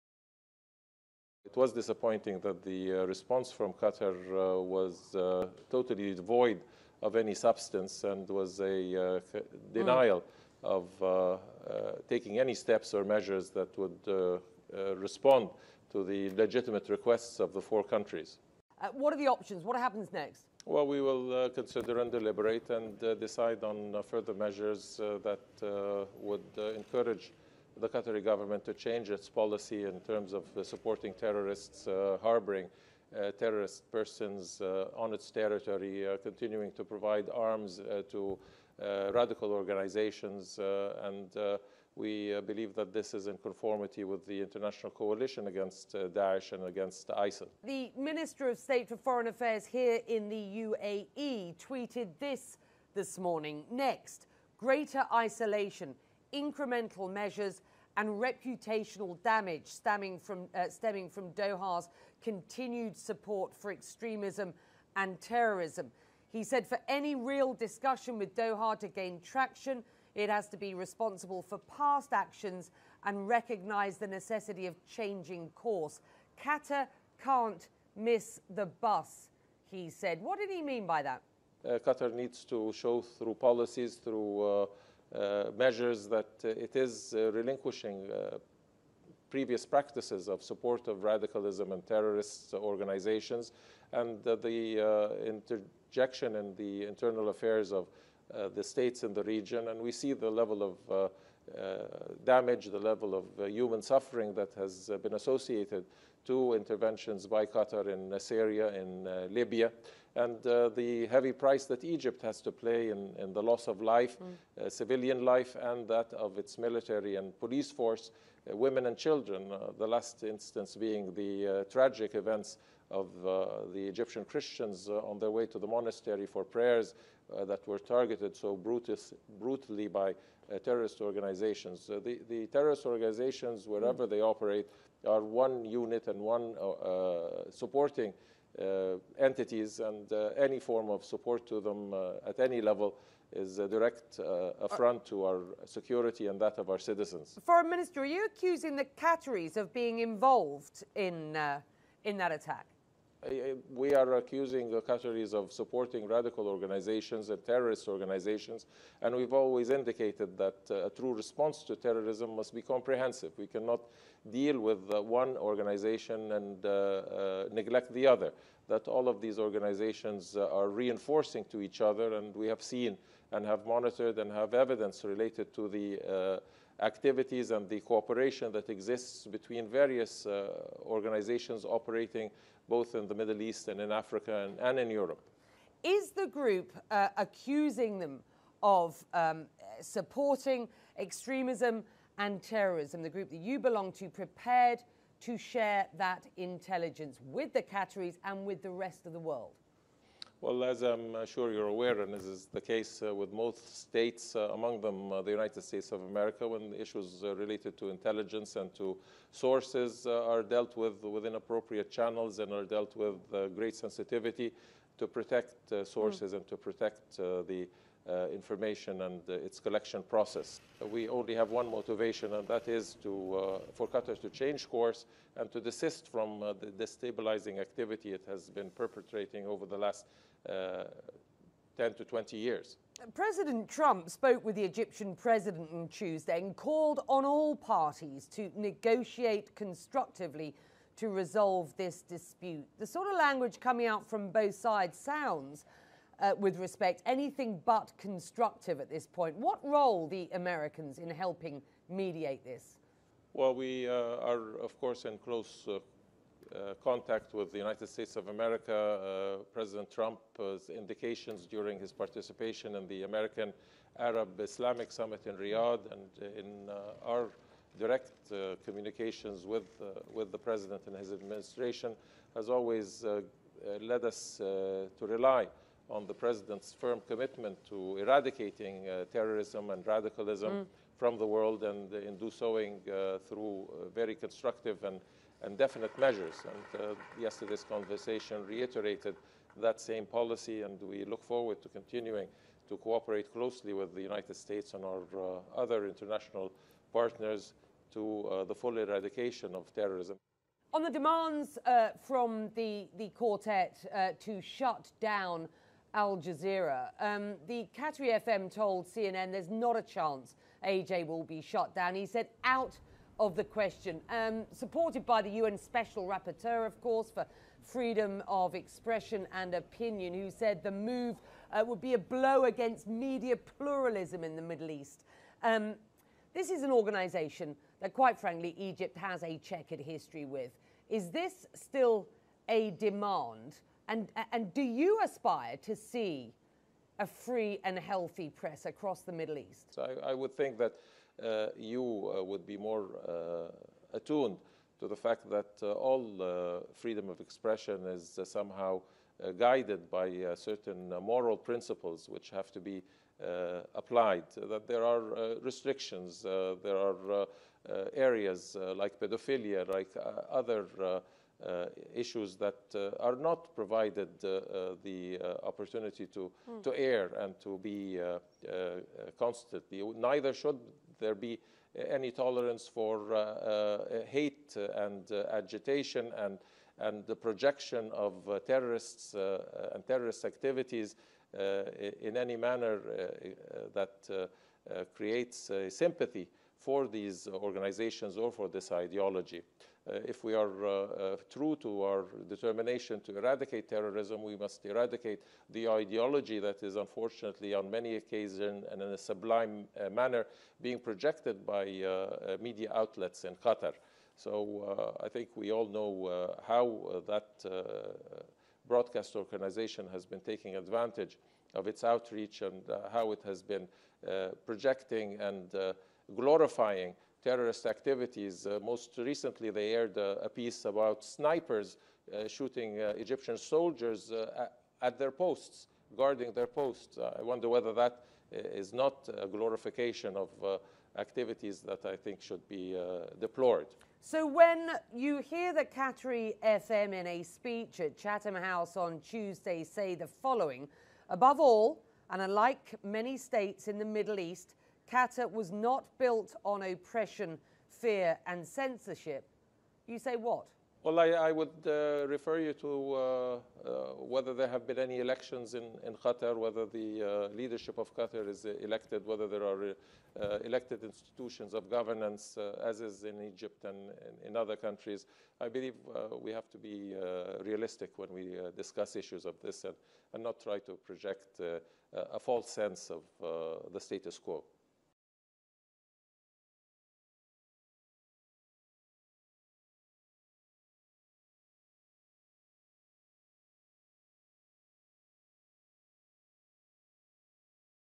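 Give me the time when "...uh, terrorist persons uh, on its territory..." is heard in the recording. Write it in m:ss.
0:33.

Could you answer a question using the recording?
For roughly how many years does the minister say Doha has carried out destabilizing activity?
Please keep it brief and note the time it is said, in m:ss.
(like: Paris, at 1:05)
10 to 20 years, at 3:50.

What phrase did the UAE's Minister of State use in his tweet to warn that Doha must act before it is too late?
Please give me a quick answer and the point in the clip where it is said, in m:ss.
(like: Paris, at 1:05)
miss the bus, at 1:17.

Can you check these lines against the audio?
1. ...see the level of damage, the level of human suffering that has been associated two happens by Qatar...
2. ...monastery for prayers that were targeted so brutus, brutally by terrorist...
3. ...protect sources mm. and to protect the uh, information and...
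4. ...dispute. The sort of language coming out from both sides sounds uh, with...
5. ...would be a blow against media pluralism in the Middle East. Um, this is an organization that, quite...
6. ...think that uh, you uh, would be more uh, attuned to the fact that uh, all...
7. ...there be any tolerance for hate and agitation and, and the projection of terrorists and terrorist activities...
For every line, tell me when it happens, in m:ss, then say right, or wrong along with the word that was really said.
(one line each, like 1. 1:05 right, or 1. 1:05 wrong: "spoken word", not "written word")
1. 1:39 wrong: "interventions", not "happens"
2. 2:05 right
3. 3:35 right
4. 4:02 right
5. 5:21 right
6. 5:40 right
7. 6:10 right.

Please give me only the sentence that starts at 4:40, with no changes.
from the world and in do soing uh, through uh, very constructive and, and definite measures.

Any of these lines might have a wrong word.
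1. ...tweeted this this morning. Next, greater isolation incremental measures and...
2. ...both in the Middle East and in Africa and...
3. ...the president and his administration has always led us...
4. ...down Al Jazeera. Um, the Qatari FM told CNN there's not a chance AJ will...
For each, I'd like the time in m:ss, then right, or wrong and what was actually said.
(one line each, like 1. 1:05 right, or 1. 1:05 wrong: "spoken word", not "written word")
1. 0:51 right
2. 3:02 right
3. 4:30 right
4. 5:05 right.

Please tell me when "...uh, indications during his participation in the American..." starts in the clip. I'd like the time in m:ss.
4:20.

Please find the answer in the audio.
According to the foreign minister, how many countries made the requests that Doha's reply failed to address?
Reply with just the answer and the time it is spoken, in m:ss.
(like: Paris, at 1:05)
4, at 0:17.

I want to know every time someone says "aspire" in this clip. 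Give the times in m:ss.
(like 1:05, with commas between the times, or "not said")
5:35.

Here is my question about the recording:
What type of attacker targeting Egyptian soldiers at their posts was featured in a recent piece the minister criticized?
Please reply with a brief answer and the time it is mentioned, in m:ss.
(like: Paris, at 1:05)
Snipers, at 7:01.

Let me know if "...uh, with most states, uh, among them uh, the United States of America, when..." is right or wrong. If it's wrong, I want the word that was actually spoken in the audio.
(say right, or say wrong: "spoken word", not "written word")
right.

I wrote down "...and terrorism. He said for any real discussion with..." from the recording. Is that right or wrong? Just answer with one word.
right.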